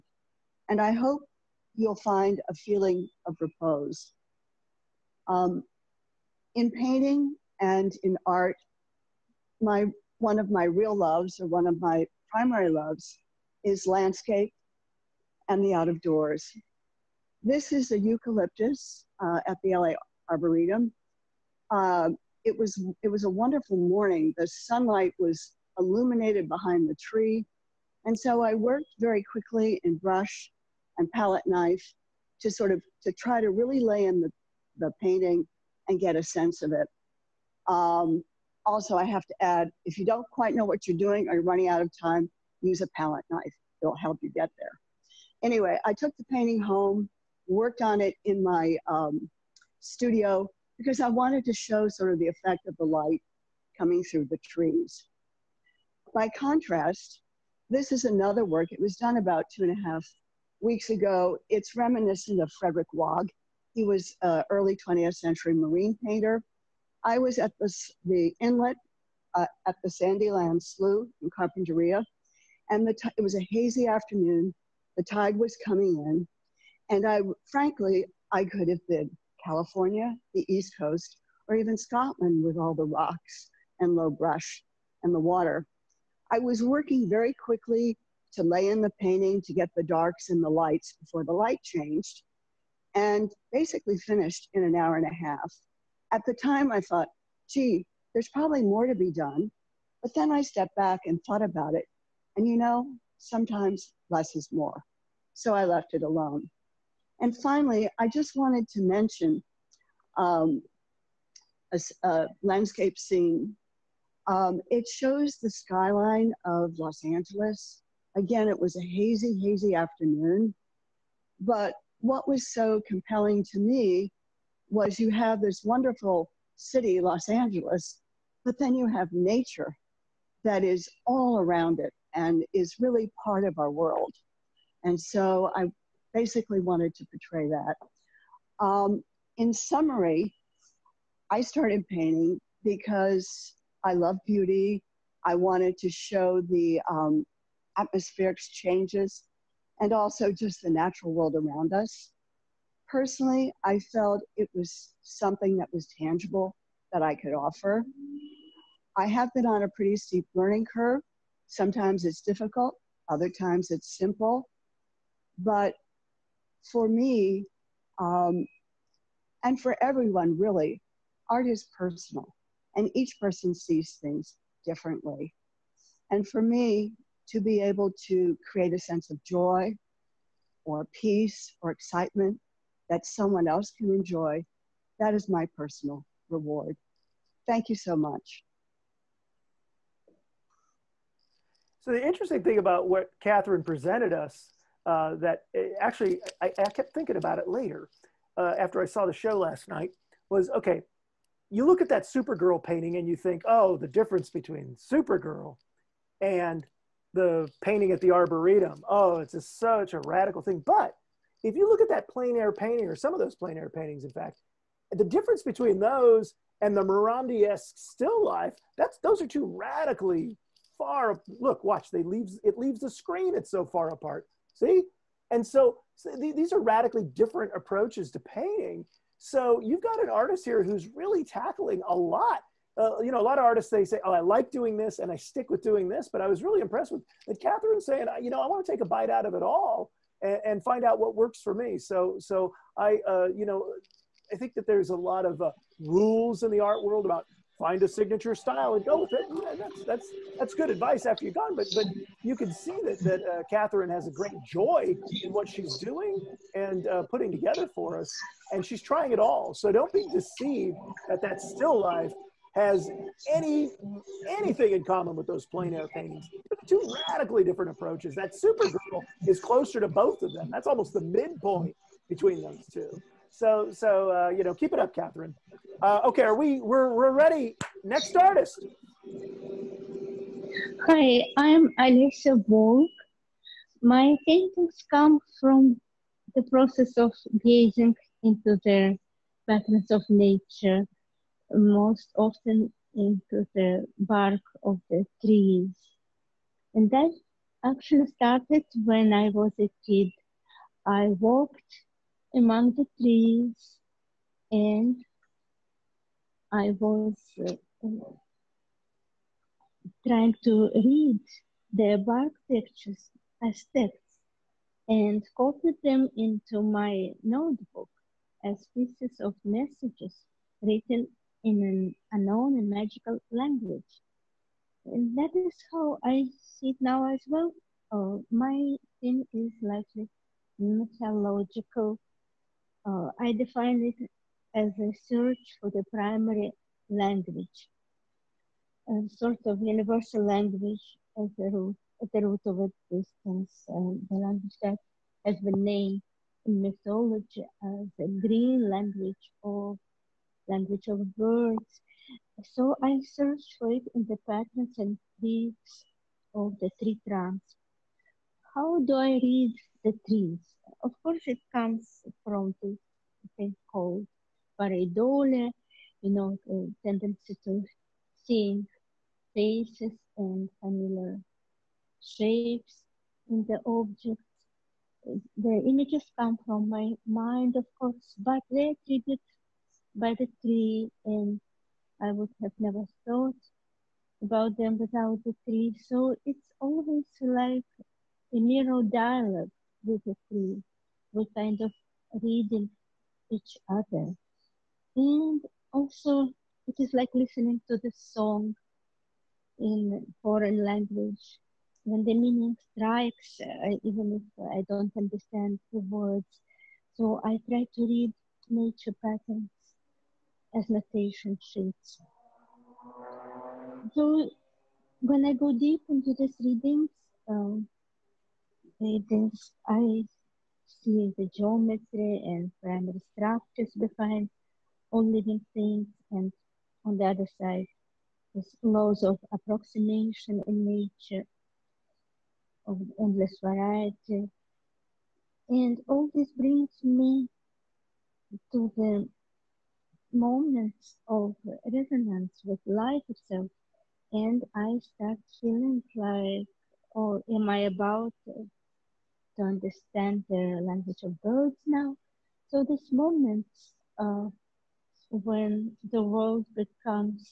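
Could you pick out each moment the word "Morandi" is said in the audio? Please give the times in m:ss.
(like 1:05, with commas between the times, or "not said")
3:36.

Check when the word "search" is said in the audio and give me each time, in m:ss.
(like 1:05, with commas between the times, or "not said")
5:35, 5:53.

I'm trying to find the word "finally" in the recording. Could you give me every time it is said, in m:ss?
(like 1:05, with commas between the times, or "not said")
1:47.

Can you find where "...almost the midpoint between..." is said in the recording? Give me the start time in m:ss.
4:30.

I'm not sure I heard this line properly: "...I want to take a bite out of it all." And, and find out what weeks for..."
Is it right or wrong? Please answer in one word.
wrong.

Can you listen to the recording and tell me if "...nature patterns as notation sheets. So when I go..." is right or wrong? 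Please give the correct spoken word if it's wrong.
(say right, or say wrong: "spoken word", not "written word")
right.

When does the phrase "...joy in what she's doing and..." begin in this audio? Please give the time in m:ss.
4:14.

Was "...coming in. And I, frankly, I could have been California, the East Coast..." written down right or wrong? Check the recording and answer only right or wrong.
right.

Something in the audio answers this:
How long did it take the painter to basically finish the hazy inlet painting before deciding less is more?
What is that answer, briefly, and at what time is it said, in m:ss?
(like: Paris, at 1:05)
an hour and a half, at 1:34.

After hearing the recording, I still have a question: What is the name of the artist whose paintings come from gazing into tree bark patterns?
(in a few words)
Olyessa Volk.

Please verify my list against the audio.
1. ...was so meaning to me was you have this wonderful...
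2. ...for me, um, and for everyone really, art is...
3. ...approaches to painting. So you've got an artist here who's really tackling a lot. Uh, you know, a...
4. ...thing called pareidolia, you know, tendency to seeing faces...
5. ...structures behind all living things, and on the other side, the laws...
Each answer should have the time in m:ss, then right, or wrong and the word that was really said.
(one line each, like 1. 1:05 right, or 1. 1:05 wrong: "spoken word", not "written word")
1. 2:02 wrong: "compelling", not "meaning"
2. 2:46 right
3. 3:47 right
4. 6:03 right
5. 7:03 right.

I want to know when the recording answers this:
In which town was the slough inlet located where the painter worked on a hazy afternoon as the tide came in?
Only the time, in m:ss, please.
1:11.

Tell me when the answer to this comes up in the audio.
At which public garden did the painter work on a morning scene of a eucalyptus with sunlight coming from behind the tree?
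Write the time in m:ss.
0:19.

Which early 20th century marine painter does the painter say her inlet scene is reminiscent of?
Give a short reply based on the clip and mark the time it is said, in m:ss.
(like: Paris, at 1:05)
Frederick Waugh, at 1:02.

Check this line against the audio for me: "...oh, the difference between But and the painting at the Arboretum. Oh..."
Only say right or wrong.
wrong.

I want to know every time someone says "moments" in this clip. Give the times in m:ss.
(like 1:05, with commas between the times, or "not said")
7:20, 7:32.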